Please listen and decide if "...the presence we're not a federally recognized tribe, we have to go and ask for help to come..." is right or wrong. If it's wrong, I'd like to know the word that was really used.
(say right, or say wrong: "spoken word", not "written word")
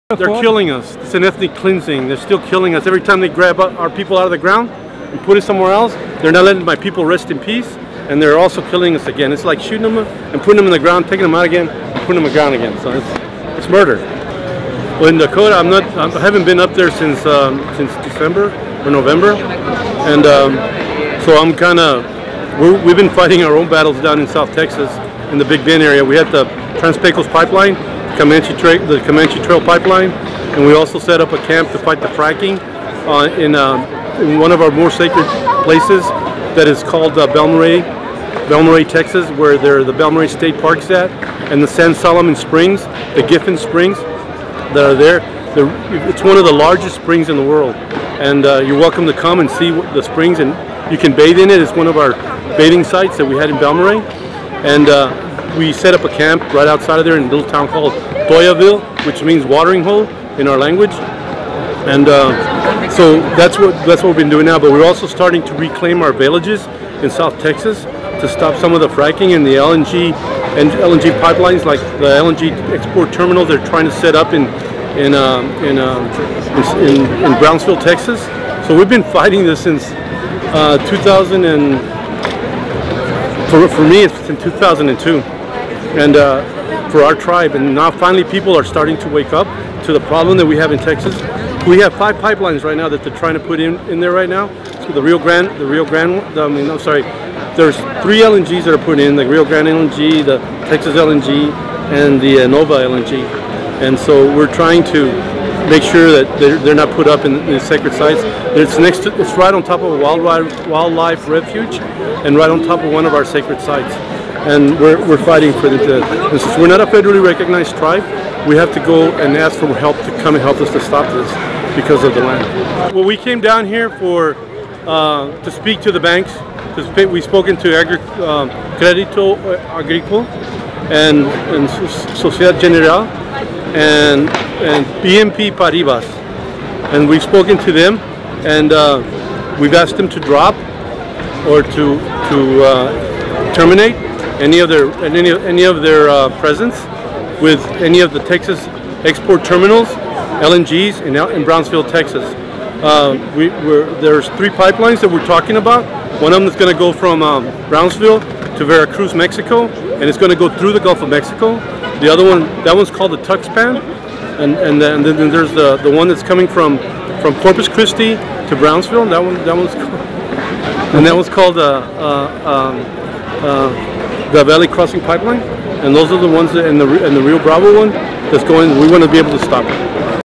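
wrong: "since", not "presence".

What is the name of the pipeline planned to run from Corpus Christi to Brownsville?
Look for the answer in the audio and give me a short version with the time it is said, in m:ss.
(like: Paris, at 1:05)
Valley Crossing Pipeline, at 2:54.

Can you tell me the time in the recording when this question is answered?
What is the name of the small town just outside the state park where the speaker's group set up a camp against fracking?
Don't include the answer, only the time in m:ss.
0:58.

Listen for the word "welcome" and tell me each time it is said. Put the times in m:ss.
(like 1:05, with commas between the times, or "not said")
0:48.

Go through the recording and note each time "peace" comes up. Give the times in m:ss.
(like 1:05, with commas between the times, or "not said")
0:07.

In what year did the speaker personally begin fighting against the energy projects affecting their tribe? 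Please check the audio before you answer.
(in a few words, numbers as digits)
2002.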